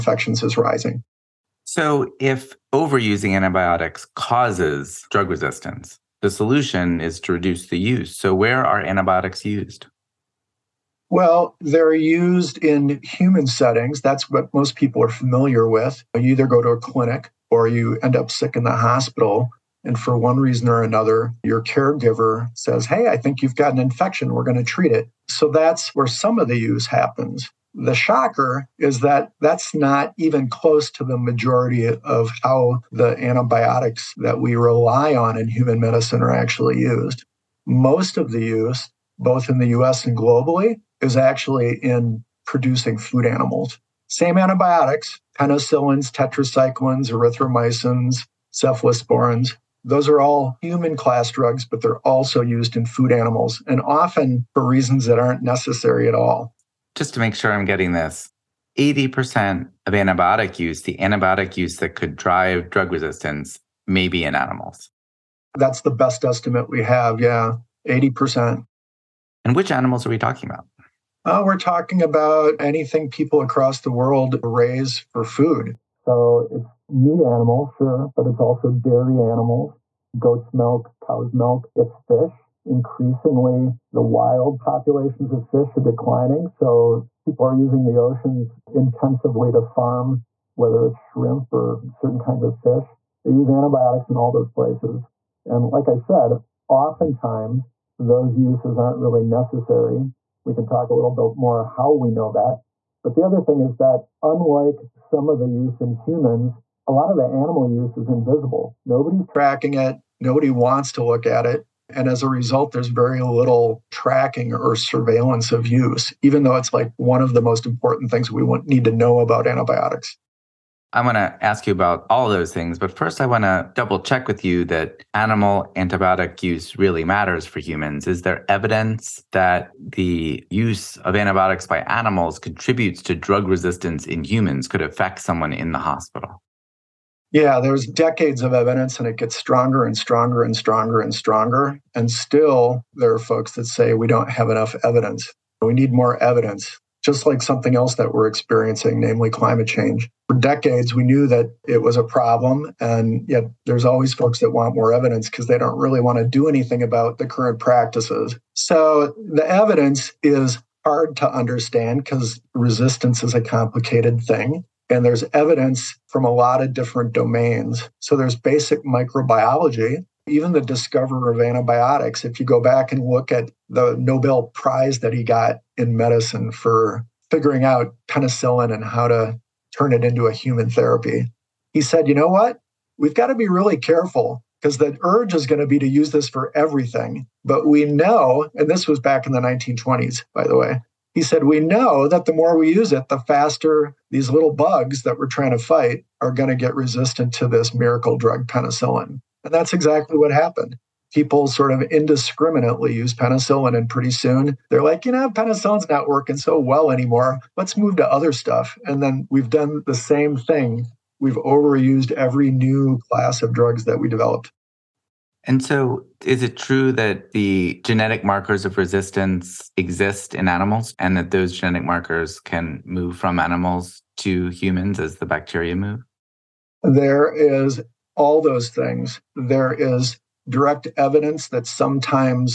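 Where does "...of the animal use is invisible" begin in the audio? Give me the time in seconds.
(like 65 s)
107 s.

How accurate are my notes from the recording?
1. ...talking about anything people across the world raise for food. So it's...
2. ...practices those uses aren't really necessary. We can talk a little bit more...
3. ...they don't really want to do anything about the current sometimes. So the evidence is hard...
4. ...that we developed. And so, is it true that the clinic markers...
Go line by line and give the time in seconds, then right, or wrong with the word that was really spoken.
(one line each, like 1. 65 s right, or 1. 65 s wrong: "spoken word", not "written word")
1. 71 s right
2. 96 s wrong: "oftentimes", not "practices"
3. 155 s wrong: "practices", not "sometimes"
4. 213 s wrong: "genetic", not "clinic".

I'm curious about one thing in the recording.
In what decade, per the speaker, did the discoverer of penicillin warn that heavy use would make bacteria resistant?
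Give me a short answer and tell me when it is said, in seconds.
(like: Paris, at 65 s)
1920s, at 189 s.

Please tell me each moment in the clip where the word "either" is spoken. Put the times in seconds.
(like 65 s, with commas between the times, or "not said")
16 s.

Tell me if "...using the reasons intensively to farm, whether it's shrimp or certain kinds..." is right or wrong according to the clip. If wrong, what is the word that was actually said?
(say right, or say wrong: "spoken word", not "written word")
wrong: "oceans", not "reasons".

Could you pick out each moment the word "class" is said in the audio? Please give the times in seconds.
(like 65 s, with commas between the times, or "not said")
50 s, 213 s.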